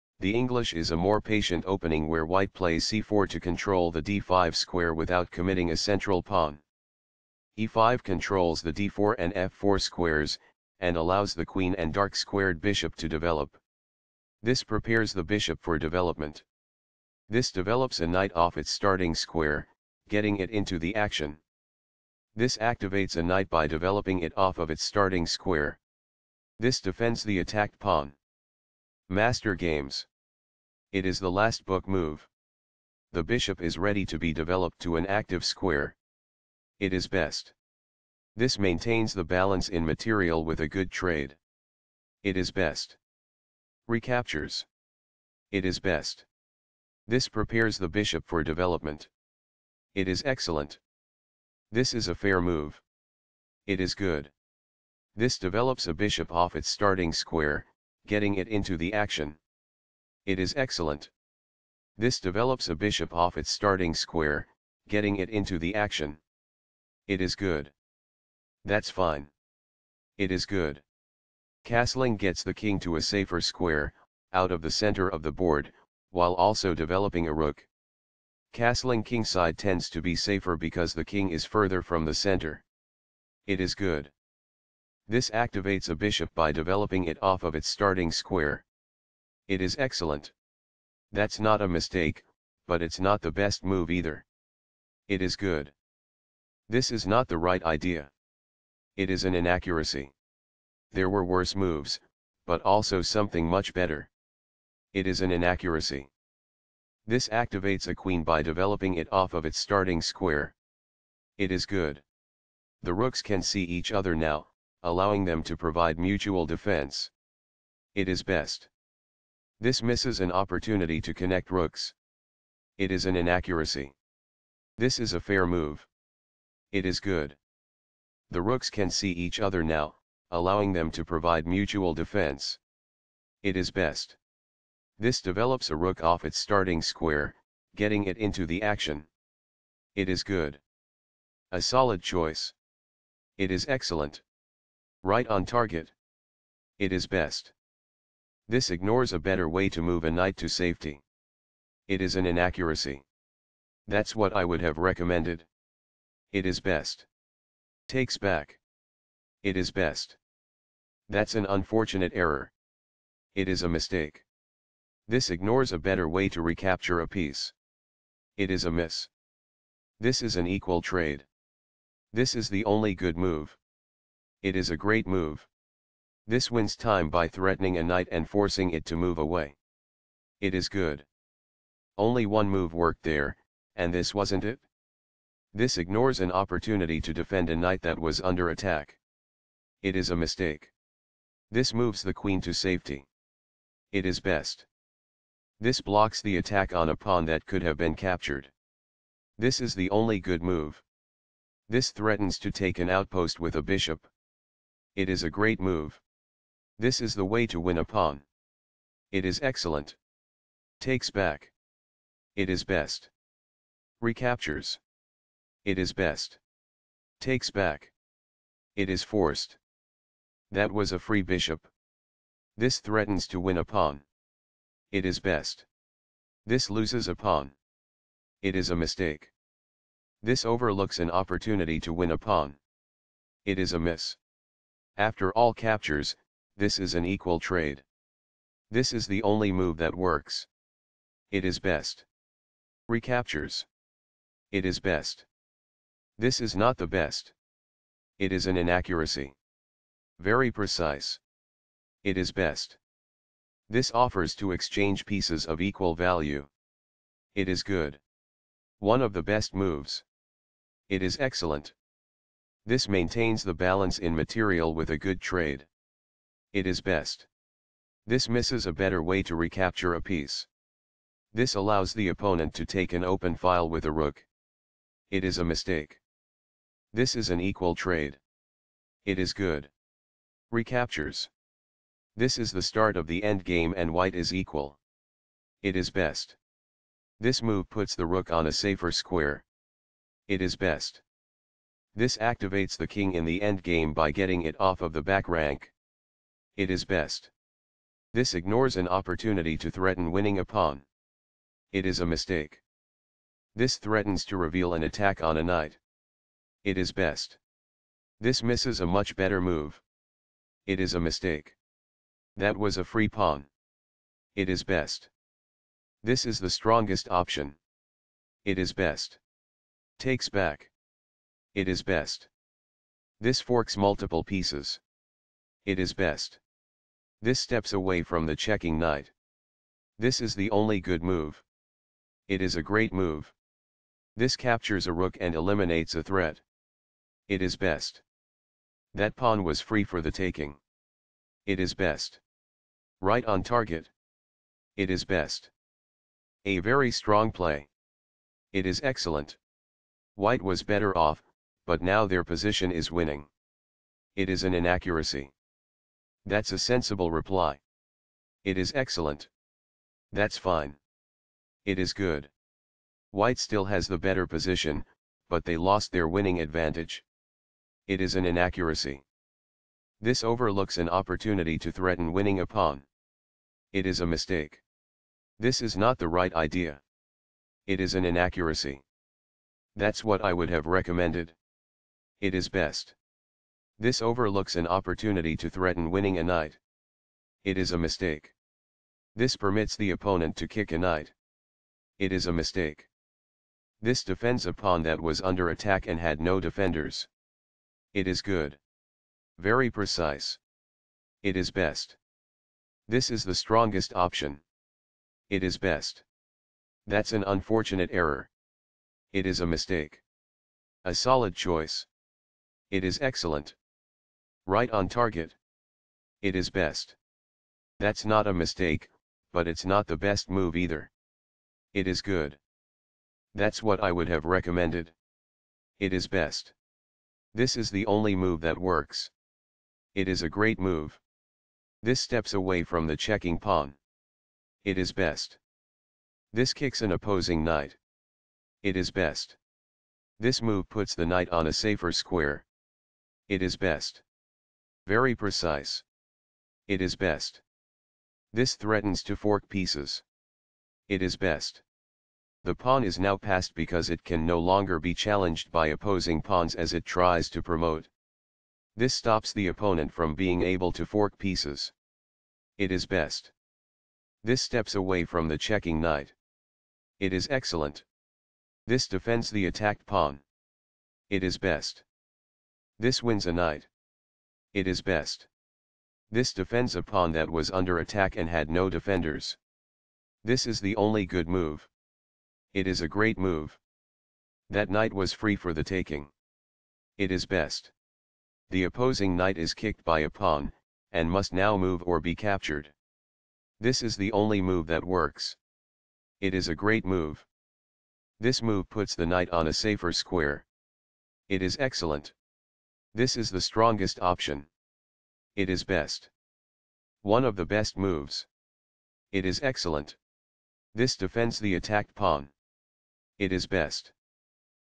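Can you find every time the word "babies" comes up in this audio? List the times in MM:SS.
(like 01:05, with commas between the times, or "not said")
not said.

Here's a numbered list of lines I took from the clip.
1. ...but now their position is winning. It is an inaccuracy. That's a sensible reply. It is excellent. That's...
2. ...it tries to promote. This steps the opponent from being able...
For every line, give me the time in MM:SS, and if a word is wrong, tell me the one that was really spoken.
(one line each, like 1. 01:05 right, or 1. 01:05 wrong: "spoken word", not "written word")
1. 05:51 right
2. 07:36 wrong: "stops", not "steps".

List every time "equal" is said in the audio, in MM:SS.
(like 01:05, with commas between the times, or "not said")
02:50, 03:57, 04:15, 04:37, 04:44.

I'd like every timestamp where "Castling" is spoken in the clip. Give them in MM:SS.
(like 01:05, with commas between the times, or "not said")
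01:11, 01:18.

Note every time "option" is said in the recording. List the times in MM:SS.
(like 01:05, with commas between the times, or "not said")
05:17, 06:43, 08:24.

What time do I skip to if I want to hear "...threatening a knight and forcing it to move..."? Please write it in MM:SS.
02:57.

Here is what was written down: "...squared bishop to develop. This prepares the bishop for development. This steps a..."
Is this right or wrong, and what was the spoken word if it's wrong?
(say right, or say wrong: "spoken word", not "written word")
wrong: "develops", not "steps".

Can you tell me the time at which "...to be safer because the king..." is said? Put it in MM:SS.
01:19.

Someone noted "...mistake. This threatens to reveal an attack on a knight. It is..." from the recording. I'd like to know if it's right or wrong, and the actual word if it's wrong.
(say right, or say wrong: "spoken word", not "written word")
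right.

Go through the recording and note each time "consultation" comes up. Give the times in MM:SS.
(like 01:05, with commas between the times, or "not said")
not said.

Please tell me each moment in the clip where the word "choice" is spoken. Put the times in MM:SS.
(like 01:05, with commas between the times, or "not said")
02:22, 06:51.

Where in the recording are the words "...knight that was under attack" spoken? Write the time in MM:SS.
03:07.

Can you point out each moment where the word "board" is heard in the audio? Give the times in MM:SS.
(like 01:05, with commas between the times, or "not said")
01:15.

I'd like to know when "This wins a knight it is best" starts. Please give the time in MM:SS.
07:52.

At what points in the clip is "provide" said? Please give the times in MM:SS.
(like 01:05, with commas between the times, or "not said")
01:55, 02:11.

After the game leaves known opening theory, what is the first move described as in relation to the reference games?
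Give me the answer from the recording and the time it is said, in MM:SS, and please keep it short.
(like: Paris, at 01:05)
the last book move, at 00:31.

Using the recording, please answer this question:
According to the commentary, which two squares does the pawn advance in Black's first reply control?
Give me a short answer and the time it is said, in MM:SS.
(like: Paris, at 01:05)
d4 and f4, at 00:08.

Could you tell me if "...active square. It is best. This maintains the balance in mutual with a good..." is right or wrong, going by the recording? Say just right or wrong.
wrong.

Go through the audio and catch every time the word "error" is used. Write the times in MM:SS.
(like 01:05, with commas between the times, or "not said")
02:42, 06:47.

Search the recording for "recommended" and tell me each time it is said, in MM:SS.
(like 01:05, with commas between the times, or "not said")
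02:34, 06:20, 07:04.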